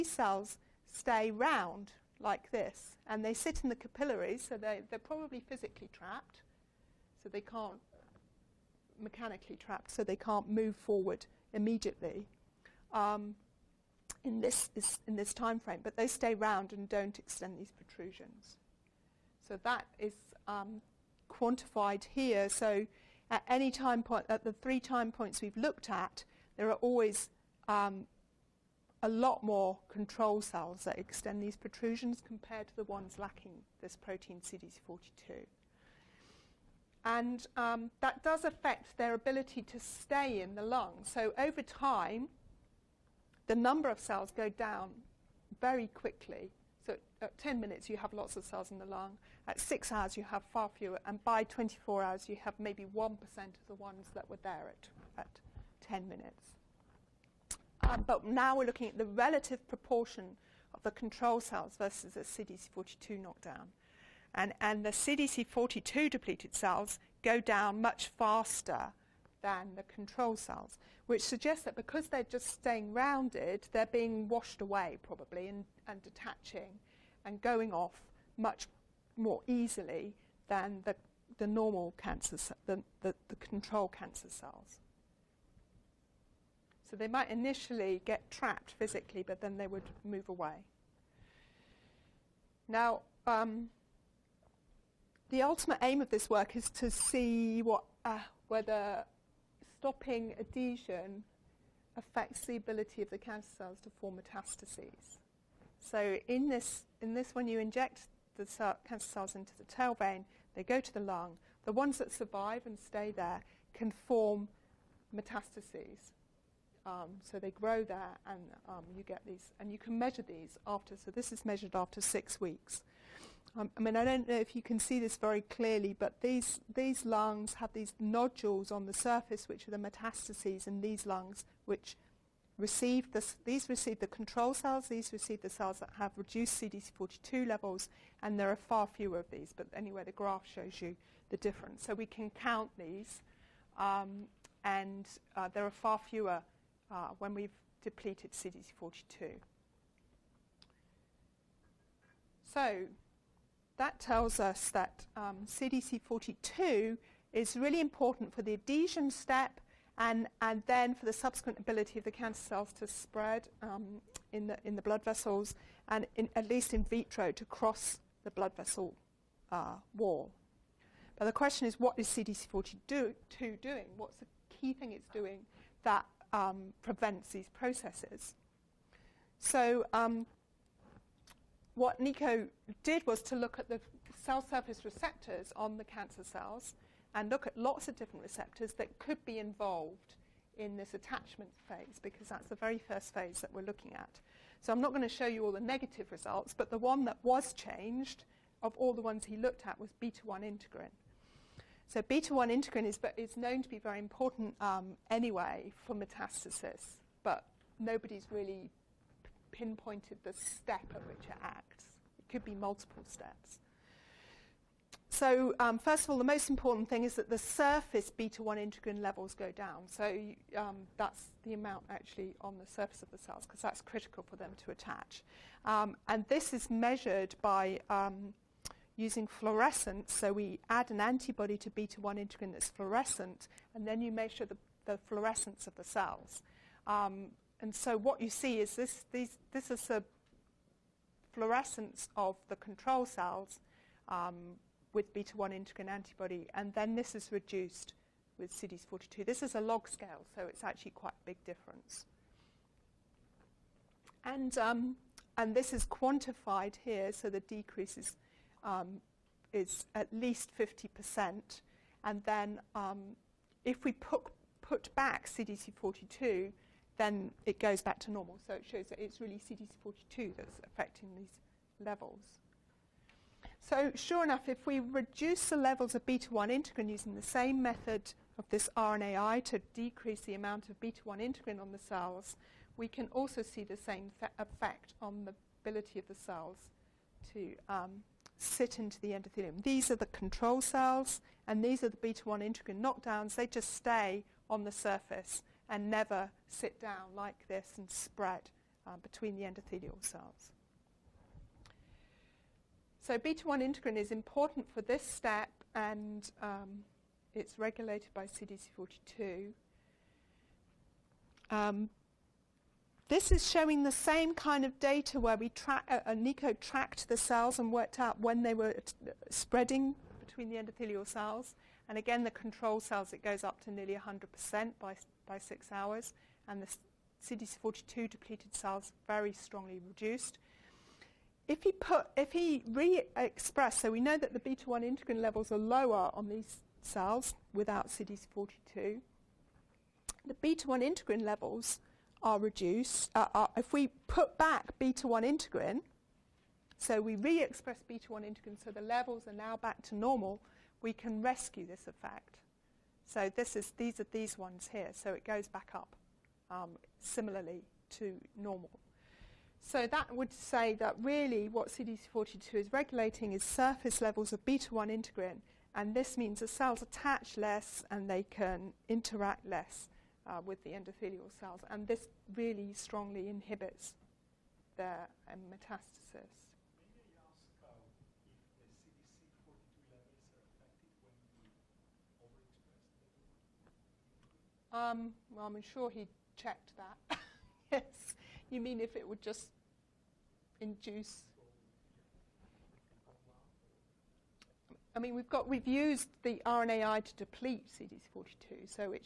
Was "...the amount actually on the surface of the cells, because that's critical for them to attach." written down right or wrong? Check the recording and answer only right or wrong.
right.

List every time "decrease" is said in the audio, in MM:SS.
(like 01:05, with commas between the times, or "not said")
04:17, 04:39.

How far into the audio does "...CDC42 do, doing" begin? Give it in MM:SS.
02:52.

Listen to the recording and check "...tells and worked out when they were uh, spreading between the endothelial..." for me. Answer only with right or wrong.
wrong.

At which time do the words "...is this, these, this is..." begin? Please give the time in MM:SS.
03:58.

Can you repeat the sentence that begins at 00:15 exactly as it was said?
But they stay round and don't extend these protrusions.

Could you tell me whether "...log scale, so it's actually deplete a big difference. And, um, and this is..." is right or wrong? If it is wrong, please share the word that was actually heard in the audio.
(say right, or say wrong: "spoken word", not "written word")
wrong: "quite", not "deplete".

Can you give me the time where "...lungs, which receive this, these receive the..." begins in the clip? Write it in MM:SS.
02:11.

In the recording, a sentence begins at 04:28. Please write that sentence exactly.
So it shows that it's really CDC42 that's affecting these levels.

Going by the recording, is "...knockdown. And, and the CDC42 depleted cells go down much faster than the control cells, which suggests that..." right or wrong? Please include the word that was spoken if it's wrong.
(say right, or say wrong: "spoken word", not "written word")
right.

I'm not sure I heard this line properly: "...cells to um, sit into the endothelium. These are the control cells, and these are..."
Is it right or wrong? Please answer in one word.
right.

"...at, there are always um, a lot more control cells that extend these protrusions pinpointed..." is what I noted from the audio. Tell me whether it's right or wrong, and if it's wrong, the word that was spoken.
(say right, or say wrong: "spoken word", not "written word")
wrong: "compared", not "pinpointed".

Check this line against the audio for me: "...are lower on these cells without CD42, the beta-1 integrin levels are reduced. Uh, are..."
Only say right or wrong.
right.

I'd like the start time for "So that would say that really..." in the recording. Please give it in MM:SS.
05:59.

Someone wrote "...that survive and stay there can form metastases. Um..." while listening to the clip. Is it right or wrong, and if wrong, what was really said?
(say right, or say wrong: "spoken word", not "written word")
right.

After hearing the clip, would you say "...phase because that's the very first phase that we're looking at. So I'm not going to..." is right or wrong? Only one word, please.
right.